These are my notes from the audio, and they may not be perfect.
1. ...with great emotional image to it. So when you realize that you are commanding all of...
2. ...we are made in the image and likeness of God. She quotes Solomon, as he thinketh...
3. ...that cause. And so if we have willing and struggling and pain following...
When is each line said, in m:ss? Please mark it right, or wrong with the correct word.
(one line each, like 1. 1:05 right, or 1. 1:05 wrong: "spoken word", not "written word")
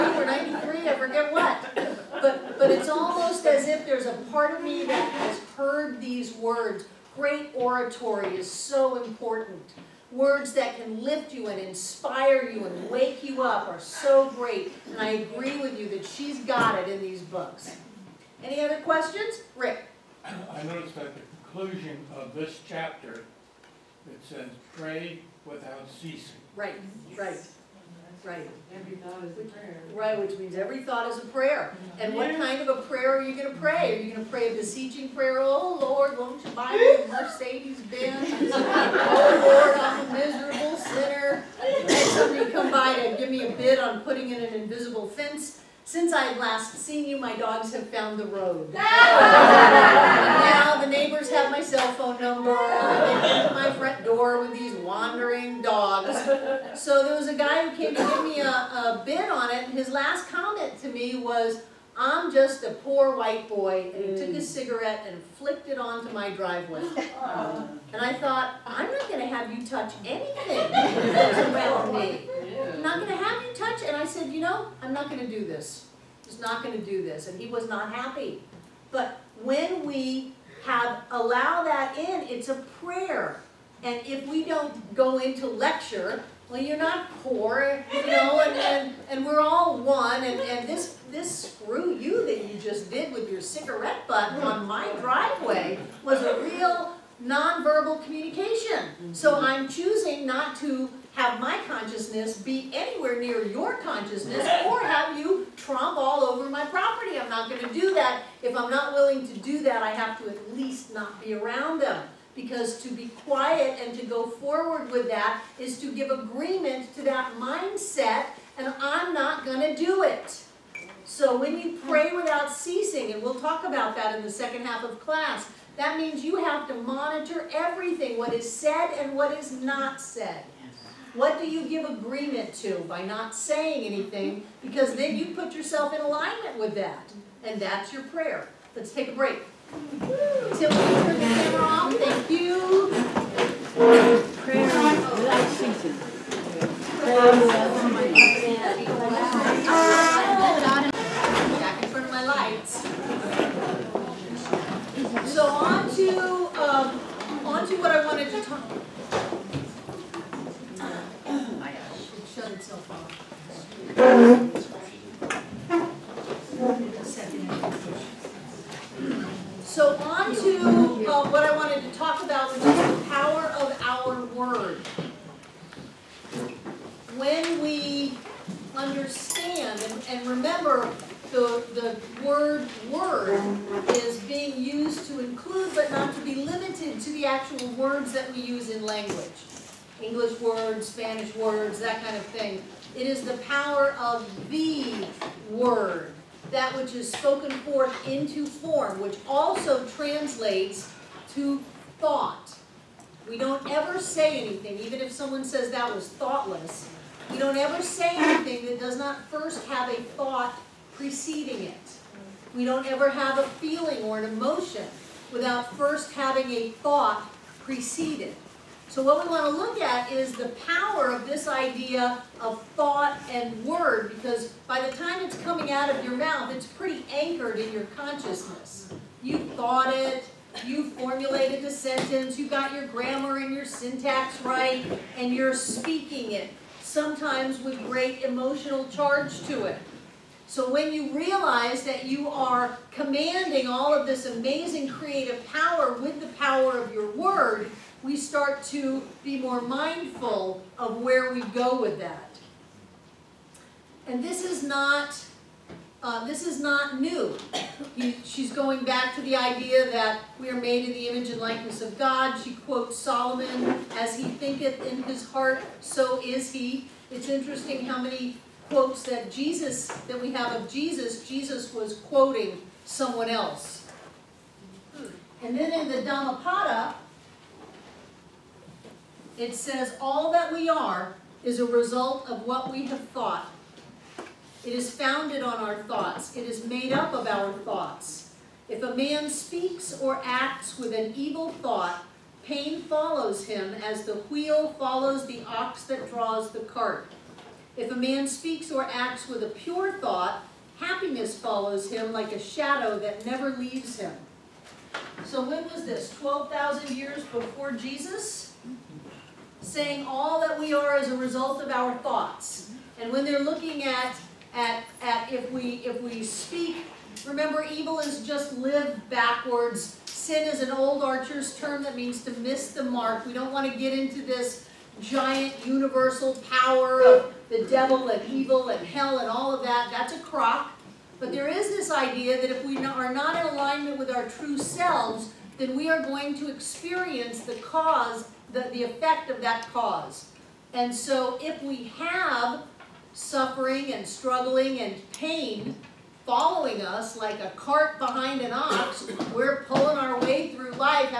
1. 3:57 wrong: "charge", not "image"
2. 4:20 right
3. 5:39 wrong: "suffering", not "willing".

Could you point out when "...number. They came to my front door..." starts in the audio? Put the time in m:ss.
0:52.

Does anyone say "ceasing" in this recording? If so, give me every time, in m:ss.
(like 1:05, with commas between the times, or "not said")
0:26, 2:02, 2:25, 2:29.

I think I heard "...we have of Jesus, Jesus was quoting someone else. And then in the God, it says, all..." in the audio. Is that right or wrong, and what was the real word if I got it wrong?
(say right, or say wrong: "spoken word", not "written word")
wrong: "Dhammapada", not "God".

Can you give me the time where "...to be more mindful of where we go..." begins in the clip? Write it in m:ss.
4:08.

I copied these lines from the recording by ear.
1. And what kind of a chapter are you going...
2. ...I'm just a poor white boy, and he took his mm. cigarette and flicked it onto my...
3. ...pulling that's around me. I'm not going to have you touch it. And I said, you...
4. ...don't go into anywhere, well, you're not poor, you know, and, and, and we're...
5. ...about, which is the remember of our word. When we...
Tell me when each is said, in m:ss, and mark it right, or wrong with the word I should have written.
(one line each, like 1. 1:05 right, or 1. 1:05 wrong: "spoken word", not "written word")
1. 0:31 wrong: "prayer", not "chapter"
2. 1:02 right
3. 1:10 wrong: "anything", not "pulling"
4. 1:24 wrong: "lecture", not "anywhere"
5. 2:52 wrong: "power", not "remember".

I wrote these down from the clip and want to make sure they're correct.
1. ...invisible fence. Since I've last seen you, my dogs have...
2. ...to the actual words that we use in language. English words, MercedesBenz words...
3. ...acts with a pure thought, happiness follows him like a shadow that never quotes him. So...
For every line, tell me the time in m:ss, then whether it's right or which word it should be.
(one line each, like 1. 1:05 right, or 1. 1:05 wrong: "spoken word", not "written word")
1. 0:44 right
2. 3:06 wrong: "Spanish", not "MercedesBenz"
3. 4:58 wrong: "leaves", not "quotes".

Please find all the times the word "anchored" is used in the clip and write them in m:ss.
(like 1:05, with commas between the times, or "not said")
3:47.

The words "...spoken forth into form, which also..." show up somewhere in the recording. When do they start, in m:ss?
3:17.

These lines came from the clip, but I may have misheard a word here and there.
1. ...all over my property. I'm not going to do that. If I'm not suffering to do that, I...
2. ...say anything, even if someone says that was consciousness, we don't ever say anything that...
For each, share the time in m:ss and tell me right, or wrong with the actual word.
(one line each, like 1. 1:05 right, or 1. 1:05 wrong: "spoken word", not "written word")
1. 1:45 wrong: "willing", not "suffering"
2. 3:23 wrong: "thoughtless", not "consciousness".